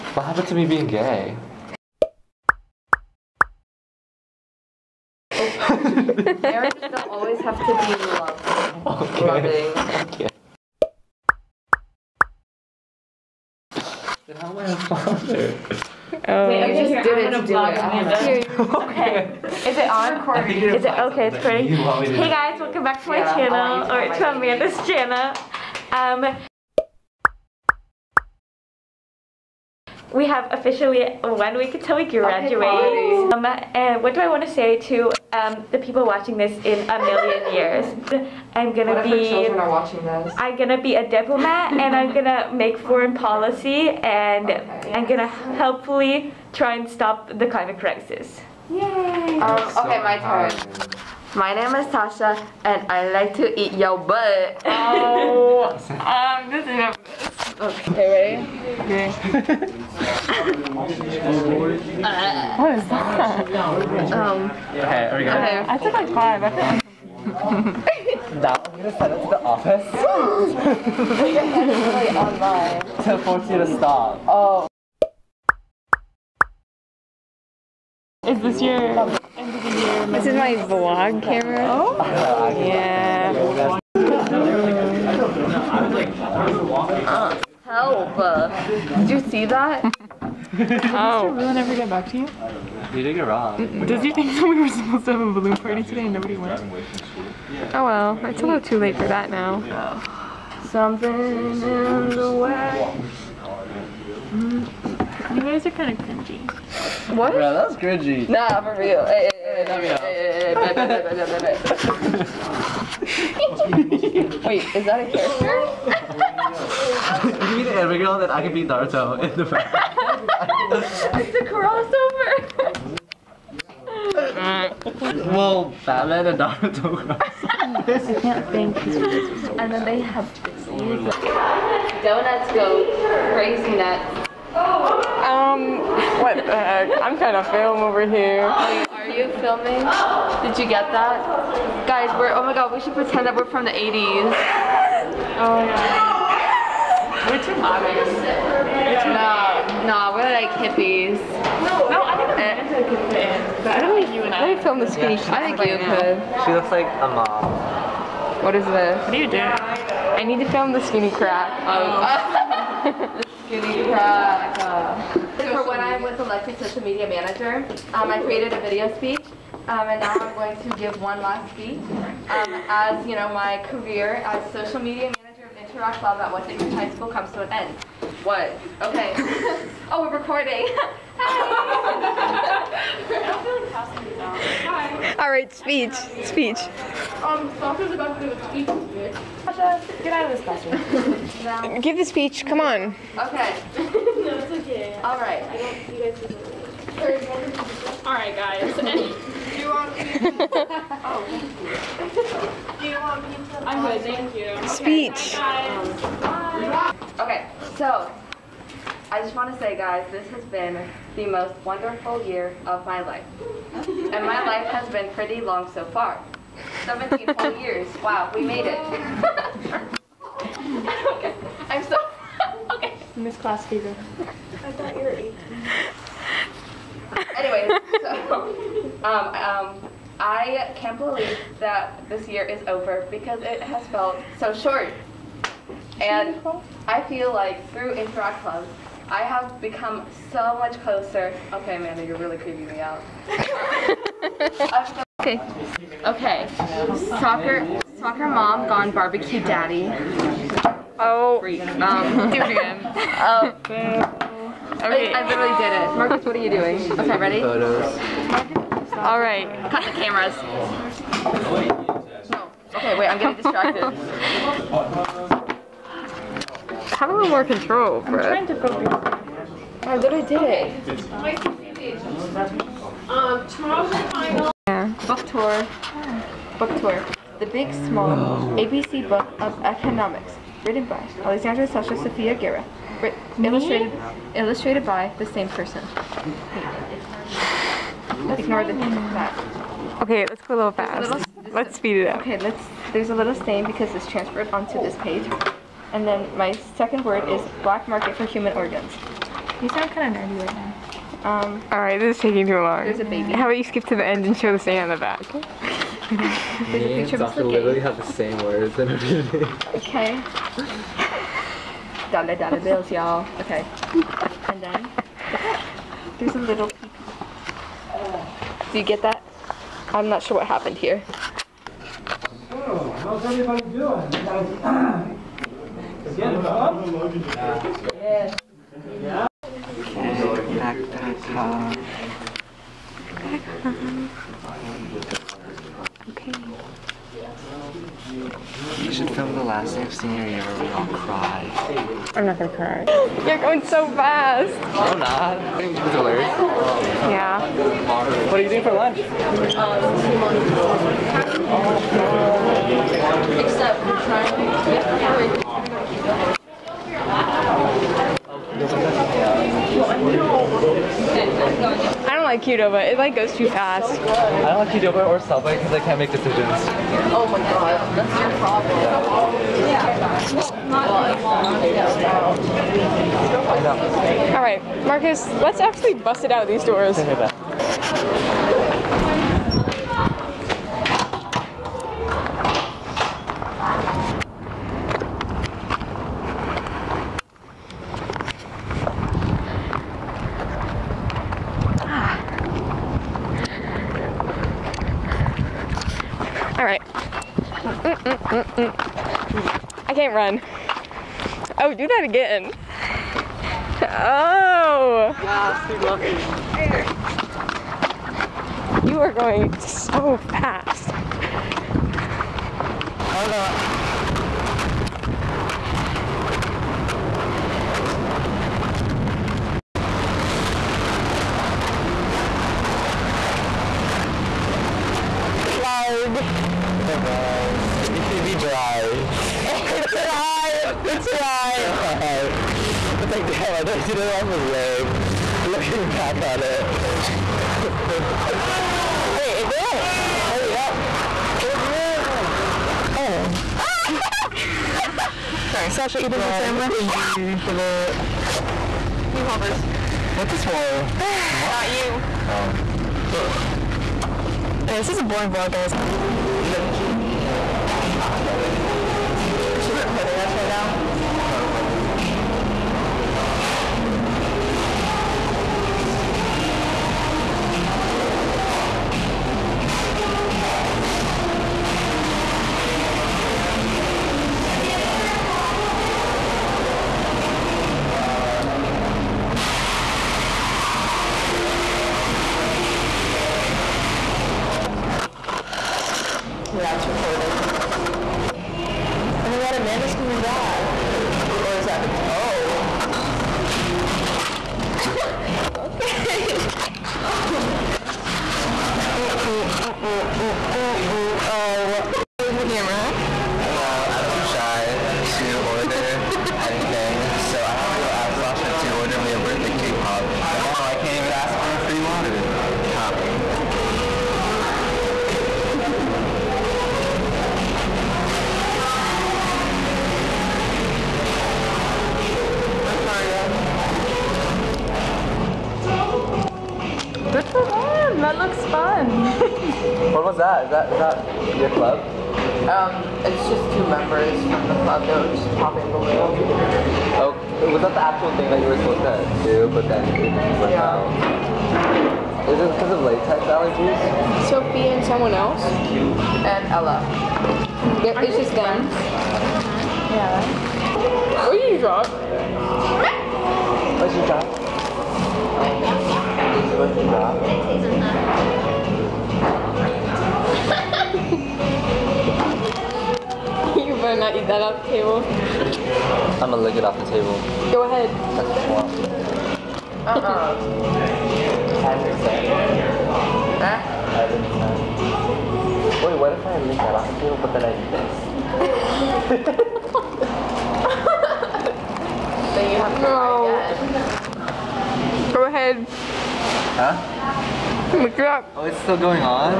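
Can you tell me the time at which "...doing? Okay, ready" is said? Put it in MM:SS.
04:16.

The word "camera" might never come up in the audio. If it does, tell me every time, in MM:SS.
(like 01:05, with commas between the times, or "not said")
01:21, 04:19, 08:22.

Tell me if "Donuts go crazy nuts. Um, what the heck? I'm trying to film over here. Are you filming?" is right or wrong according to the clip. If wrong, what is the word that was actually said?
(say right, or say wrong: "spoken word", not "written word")
right.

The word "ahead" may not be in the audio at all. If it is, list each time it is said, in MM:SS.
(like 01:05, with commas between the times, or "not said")
09:27, 09:45.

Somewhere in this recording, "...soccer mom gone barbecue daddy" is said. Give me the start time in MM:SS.
04:07.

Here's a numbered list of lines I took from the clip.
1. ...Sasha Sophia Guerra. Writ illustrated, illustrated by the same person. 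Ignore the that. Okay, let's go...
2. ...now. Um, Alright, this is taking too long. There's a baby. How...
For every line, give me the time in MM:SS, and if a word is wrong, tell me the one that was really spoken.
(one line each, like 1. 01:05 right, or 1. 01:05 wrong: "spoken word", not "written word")
1. 04:41 right
2. 05:00 right.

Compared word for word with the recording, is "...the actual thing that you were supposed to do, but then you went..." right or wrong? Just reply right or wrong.
right.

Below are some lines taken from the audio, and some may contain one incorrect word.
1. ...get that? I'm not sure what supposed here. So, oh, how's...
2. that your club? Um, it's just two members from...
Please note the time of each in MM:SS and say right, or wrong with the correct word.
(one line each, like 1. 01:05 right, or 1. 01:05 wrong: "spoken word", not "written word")
1. 05:18 wrong: "happened", not "supposed"
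2. 08:50 right.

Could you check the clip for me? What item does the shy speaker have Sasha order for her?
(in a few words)
Birthday cake pop.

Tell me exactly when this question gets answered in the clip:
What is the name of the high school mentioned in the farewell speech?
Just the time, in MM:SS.
02:56.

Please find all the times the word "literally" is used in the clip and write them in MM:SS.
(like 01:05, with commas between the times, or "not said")
04:15, 04:29, 05:07.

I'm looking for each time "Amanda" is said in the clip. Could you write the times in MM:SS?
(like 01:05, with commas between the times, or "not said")
00:24, 02:32, 04:01, 08:09.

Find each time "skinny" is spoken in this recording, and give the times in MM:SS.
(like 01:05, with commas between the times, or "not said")
02:34, 02:40.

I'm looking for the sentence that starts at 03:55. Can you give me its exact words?
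And I feel like through Interact Club, I have become so much closer.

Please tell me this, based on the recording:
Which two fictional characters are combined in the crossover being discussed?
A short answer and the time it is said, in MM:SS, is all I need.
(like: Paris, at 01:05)
Batman and Naruto, at 02:05.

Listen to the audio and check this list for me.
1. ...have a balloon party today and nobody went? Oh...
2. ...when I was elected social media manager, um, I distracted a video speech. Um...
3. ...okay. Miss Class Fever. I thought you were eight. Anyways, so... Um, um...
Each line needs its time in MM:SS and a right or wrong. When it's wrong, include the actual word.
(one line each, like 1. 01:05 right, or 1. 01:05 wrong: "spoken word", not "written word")
1. 01:35 right
2. 02:45 wrong: "created", not "distracted"
3. 03:42 right.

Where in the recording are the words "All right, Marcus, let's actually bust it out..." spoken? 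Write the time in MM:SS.
06:14.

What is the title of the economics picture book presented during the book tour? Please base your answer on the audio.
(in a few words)
The Big Small ABC Book of Economics.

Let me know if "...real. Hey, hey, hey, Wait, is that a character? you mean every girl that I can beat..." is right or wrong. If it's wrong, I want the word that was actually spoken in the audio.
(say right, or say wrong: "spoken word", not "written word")
right.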